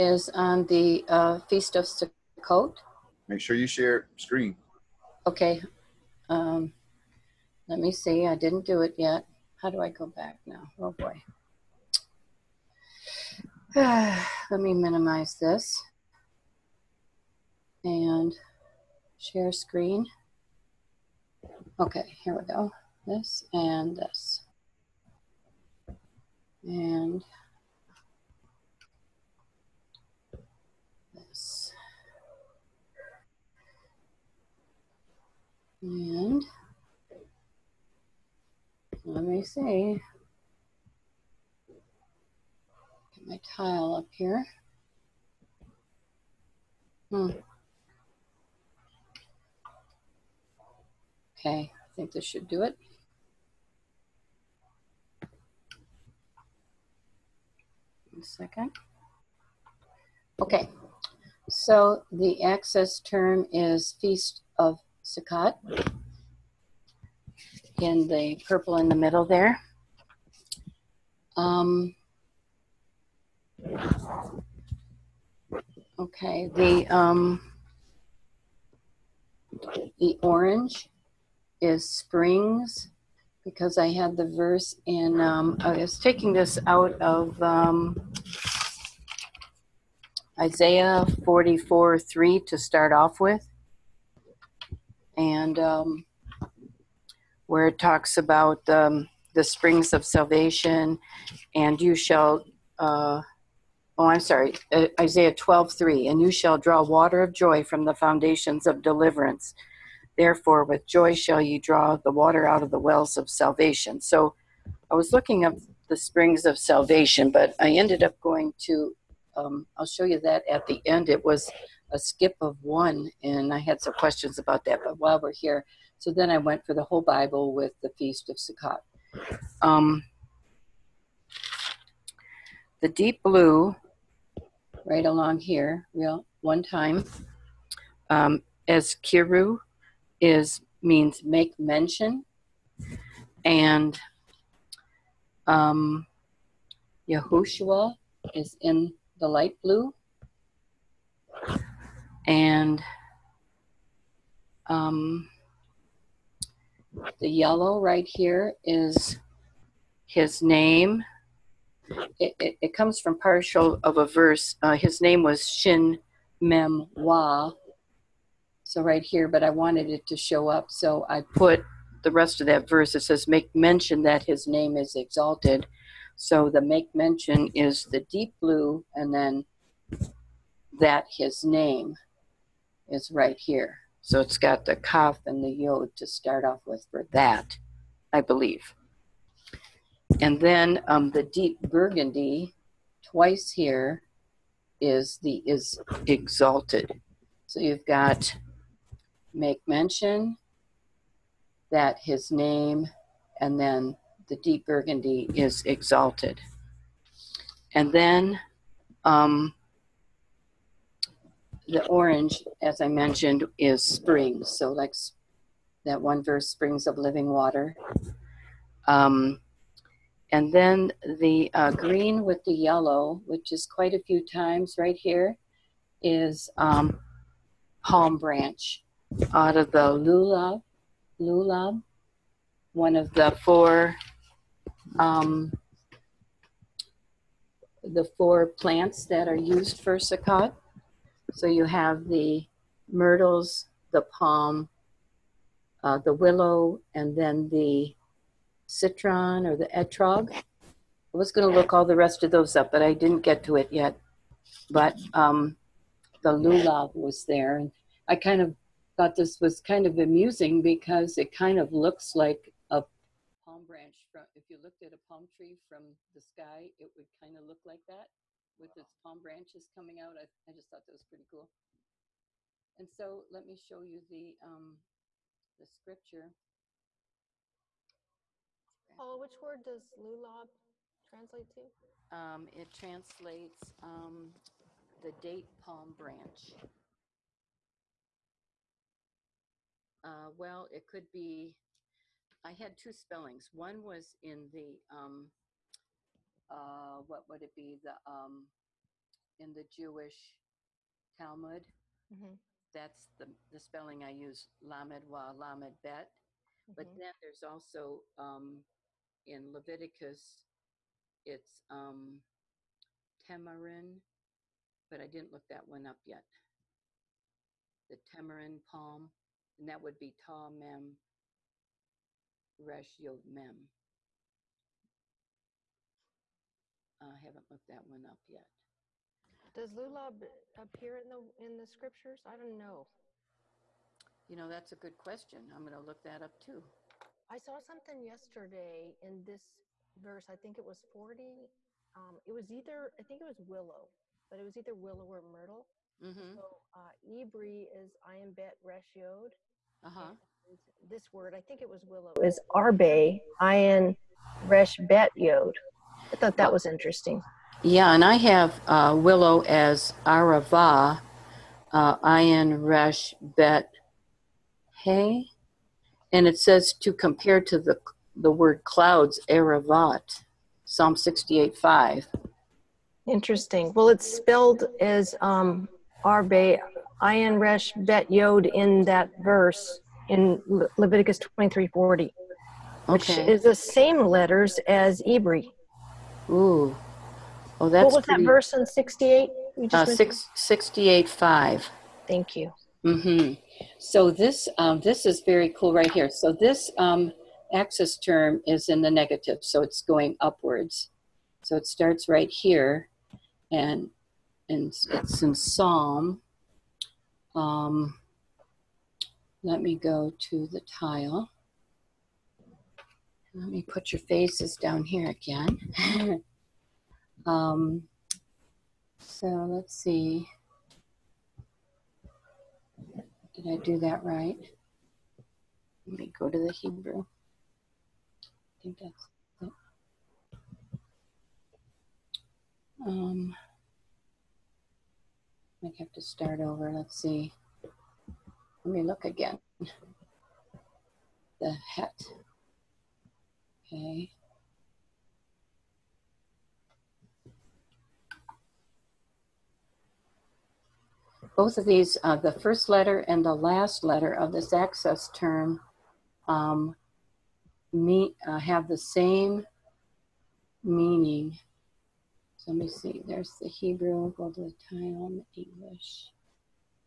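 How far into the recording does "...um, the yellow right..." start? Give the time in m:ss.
2:34.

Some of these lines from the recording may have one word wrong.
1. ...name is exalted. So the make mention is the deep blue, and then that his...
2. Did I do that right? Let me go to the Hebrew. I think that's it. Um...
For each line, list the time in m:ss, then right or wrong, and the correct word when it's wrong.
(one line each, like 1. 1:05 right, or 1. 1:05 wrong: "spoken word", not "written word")
1. 2:54 right
2. 7:03 right.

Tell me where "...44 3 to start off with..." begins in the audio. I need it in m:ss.
1:31.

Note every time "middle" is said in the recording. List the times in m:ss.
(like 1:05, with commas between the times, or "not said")
1:08.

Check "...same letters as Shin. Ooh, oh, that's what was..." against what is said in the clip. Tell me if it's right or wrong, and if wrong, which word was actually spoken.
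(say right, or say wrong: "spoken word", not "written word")
wrong: "Ibri", not "Shin".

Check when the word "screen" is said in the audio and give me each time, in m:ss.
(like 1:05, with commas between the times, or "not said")
0:04, 0:19.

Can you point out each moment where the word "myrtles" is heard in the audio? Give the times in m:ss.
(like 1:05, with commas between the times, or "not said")
4:02, 5:45.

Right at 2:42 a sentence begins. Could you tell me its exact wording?
It, it, it comes from partial of a verse.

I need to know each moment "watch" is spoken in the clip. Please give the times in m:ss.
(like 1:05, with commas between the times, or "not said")
not said.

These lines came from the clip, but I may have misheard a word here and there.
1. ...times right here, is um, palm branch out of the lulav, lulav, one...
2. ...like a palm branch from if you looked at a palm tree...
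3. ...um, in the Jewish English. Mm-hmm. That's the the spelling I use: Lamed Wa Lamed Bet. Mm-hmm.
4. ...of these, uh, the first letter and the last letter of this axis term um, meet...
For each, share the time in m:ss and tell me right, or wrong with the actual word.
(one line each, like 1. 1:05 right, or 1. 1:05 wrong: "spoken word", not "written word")
1. 3:44 right
2. 4:22 right
3. 4:58 wrong: "Talmud", not "English"
4. 7:31 right.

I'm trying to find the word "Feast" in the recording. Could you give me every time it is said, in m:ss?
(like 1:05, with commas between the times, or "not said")
0:01, 1:04, 2:07.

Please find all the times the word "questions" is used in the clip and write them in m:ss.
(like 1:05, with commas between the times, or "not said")
2:03, 5:34.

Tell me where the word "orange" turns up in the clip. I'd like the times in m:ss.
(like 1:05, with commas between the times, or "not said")
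1:20, 3:31.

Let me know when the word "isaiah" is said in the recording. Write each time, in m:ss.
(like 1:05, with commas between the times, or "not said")
1:30, 1:45.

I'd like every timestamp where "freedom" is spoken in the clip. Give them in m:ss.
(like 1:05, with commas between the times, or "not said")
not said.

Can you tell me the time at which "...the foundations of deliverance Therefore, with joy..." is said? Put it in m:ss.
1:47.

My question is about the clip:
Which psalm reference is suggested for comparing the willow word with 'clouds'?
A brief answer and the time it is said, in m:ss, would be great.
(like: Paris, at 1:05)
Psalm 68:5, at 6:10.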